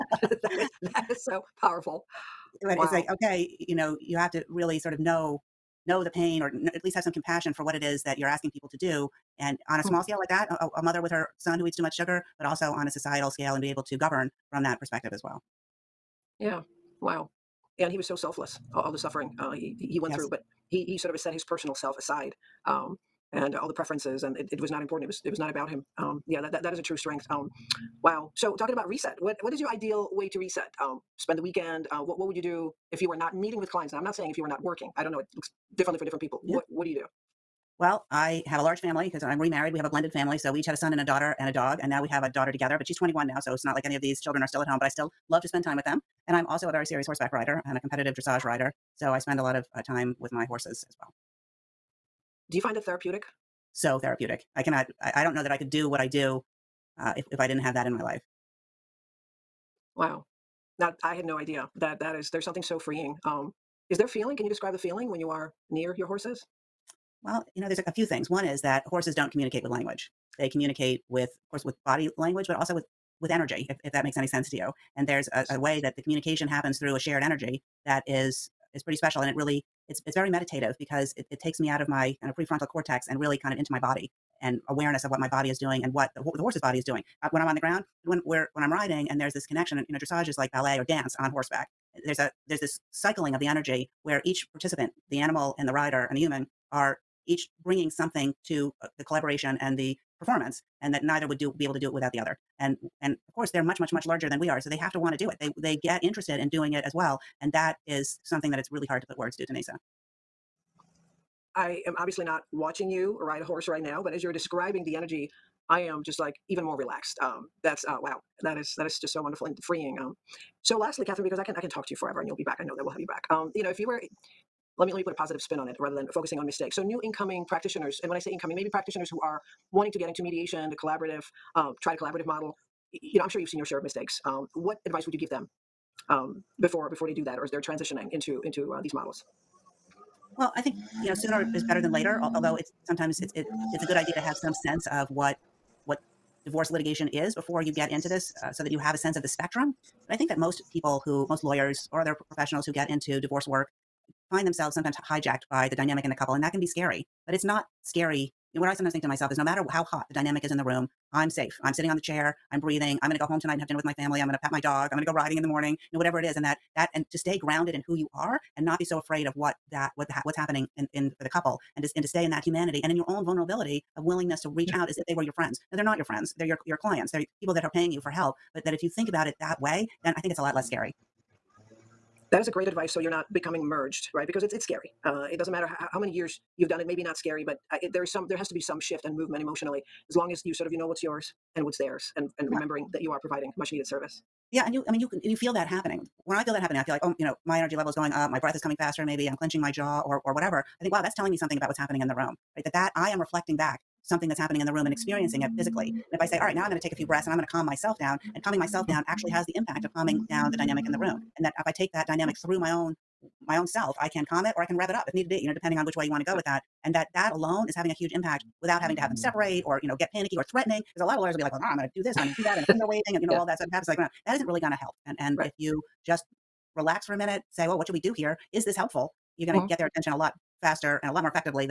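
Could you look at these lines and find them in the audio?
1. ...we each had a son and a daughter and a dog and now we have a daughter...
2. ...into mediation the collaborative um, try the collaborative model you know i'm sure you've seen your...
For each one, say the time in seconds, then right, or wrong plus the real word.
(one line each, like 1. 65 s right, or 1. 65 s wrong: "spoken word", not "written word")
1. 40 s right
2. 130 s right.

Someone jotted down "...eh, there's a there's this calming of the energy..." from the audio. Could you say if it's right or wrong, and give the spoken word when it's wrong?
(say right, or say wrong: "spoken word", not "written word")
wrong: "cycling", not "calming".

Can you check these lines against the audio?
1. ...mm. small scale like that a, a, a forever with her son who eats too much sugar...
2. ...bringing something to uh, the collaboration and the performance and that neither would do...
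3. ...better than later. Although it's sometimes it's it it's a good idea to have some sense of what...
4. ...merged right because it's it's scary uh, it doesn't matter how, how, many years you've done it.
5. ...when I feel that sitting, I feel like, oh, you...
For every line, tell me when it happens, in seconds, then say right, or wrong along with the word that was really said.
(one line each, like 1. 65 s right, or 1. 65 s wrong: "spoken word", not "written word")
1. 9 s wrong: "mother", not "forever"
2. 97 s right
3. 141 s right
4. 183 s right
5. 196 s wrong: "happening", not "sitting".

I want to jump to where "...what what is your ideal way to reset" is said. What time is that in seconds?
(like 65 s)
29 s.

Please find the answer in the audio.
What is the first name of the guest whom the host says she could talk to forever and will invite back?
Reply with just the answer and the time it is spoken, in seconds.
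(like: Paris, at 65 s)
Katherine, at 121 s.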